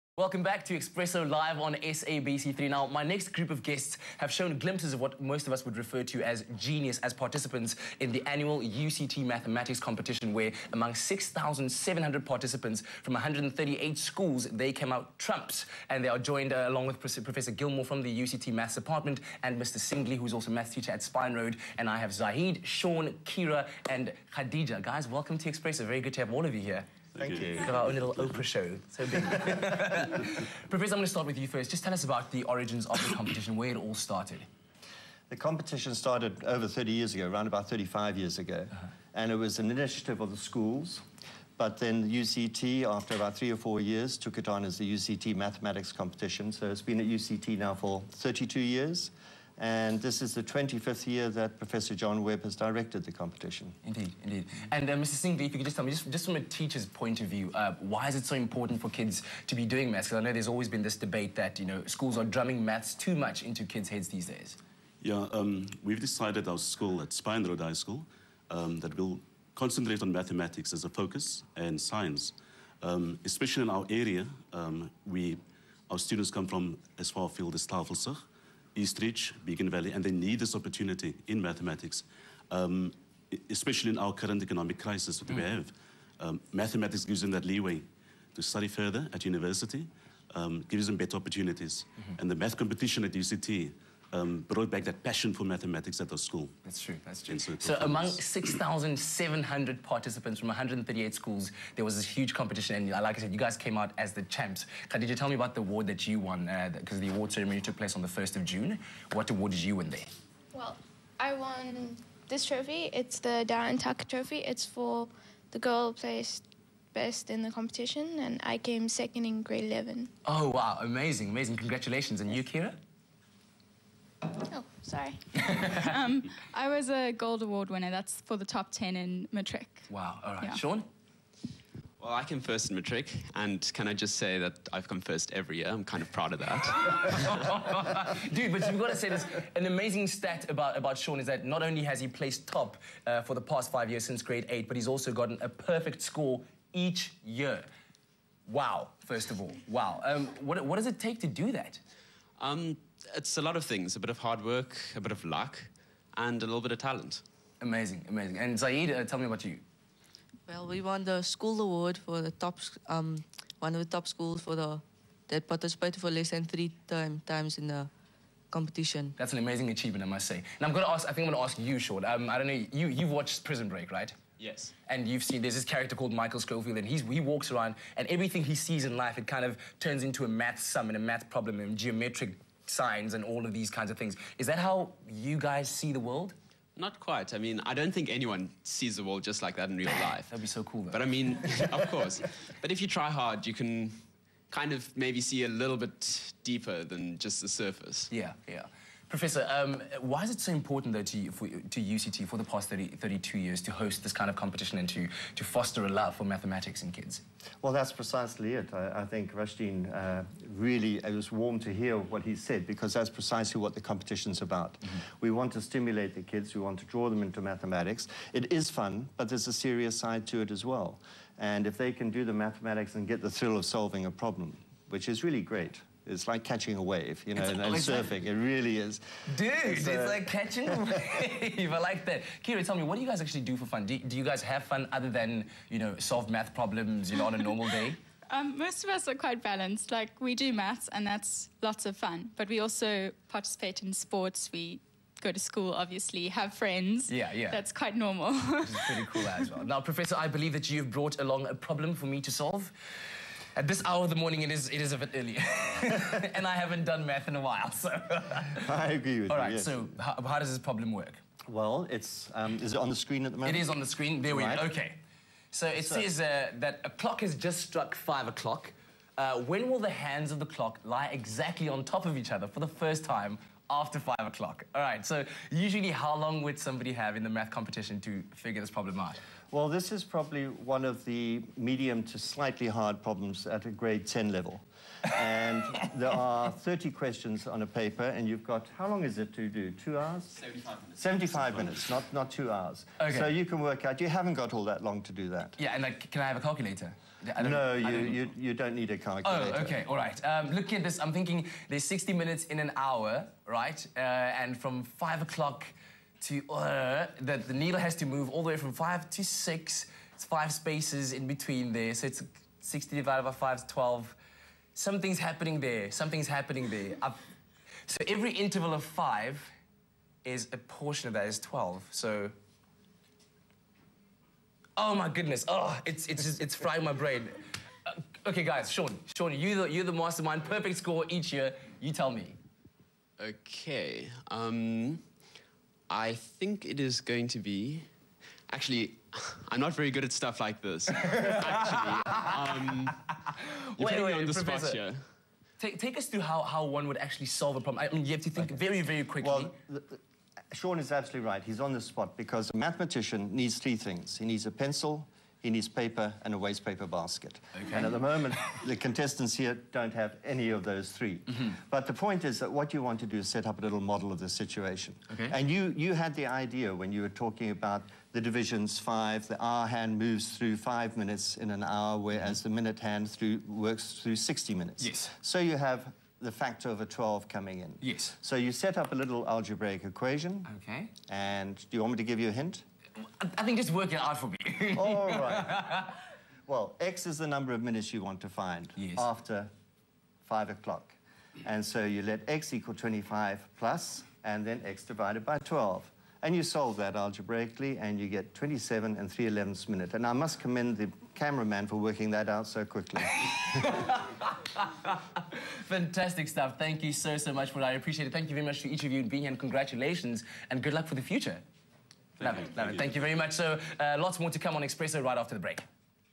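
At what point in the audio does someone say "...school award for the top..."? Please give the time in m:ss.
2:41.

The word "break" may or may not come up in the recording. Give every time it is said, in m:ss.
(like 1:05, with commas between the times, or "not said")
2:53, 6:55.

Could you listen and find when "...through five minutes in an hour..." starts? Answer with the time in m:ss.
6:10.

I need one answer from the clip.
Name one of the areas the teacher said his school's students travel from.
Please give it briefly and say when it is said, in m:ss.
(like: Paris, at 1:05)
Tafelsig, at 1:17.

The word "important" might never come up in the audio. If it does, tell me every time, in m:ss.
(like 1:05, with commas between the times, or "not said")
0:58, 3:20.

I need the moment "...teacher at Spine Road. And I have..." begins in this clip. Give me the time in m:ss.
0:20.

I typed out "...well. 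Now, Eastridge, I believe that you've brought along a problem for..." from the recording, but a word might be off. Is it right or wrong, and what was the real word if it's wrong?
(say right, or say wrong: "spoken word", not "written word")
wrong: "Professor", not "Eastridge".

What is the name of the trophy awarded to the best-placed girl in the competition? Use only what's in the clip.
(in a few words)
Darren Tucker Trophy.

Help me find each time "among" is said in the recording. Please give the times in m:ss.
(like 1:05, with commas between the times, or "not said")
0:10, 1:37.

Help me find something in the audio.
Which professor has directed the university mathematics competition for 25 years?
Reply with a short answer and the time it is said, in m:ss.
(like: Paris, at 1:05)
John Webb, at 0:51.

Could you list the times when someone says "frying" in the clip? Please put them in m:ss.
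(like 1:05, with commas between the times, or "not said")
5:26.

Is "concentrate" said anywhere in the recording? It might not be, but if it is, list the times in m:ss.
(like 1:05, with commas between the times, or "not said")
1:09.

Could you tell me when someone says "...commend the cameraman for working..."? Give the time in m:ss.
6:40.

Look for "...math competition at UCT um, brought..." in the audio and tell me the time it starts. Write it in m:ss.
1:32.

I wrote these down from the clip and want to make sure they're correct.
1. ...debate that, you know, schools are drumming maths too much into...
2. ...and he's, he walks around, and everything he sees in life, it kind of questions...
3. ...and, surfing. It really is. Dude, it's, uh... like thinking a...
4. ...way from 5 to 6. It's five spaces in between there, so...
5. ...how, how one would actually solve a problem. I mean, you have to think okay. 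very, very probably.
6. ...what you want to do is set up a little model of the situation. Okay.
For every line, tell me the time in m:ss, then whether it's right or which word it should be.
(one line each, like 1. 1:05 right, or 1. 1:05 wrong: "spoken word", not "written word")
1. 1:00 right
2. 2:56 wrong: "turns", not "questions"
3. 3:47 wrong: "catching", not "thinking"
4. 5:08 right
5. 5:46 wrong: "quickly", not "probably"
6. 6:02 right.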